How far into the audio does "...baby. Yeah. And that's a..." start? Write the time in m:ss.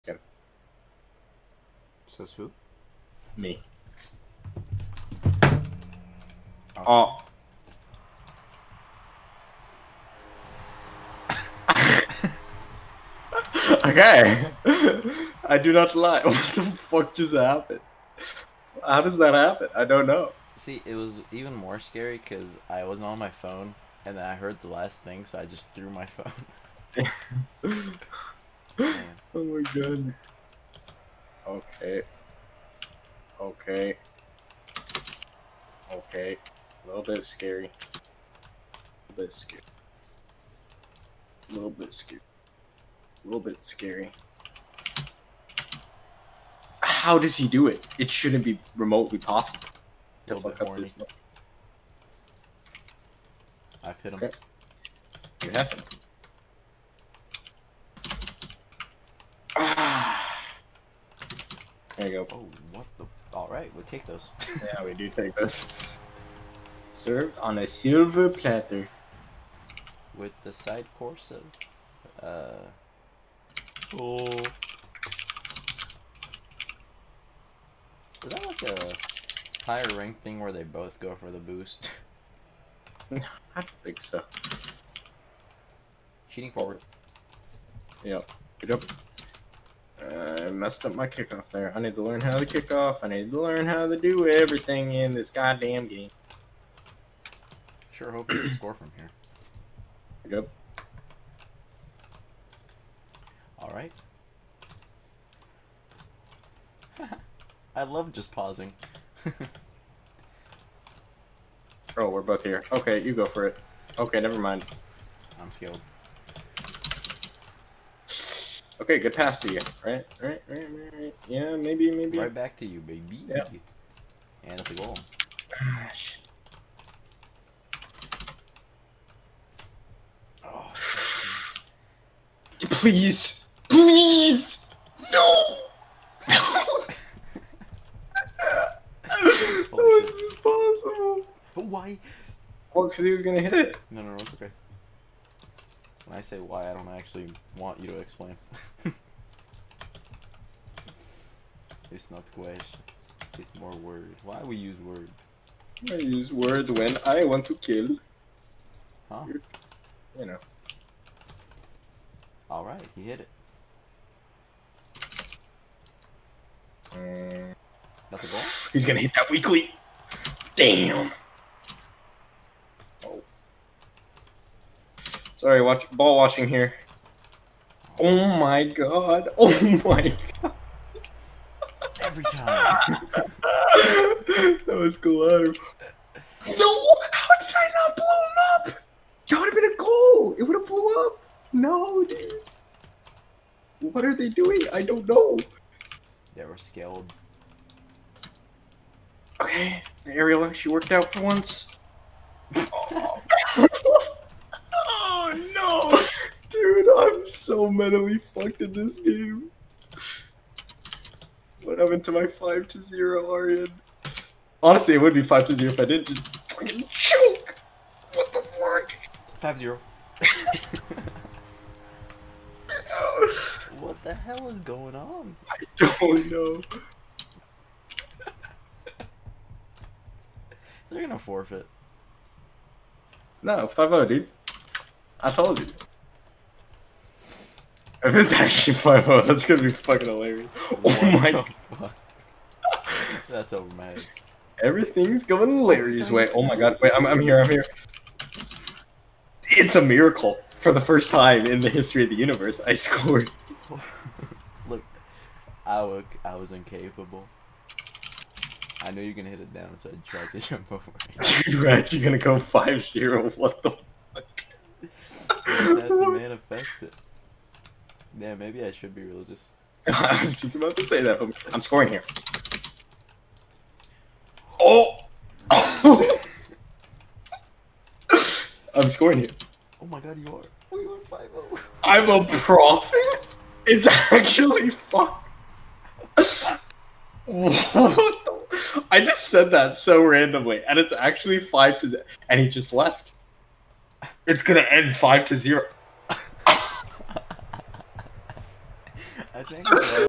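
2:02.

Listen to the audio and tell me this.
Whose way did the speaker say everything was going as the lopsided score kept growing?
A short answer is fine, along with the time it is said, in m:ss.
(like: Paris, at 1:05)
Larry's, at 4:05.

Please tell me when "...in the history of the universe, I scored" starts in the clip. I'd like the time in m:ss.
4:11.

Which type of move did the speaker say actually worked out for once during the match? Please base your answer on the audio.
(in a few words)
aerial.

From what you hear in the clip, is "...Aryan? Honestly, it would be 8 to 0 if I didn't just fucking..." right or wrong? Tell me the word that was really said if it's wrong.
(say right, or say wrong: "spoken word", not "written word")
wrong: "5", not "8".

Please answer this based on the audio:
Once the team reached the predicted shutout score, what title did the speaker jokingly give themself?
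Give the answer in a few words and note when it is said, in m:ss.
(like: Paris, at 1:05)
prophet, at 4:42.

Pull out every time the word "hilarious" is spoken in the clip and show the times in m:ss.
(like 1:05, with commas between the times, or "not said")
4:00.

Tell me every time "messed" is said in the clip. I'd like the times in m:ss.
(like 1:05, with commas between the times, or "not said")
1:30.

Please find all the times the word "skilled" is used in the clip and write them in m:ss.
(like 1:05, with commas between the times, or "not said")
1:55, 3:16.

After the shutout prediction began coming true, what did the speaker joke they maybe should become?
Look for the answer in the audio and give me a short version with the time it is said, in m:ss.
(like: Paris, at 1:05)
religious, at 4:29.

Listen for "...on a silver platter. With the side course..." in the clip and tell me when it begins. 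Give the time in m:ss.
1:07.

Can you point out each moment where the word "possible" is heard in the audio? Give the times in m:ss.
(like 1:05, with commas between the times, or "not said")
0:49, 2:20.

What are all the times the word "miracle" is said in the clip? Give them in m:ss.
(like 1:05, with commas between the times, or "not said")
4:09.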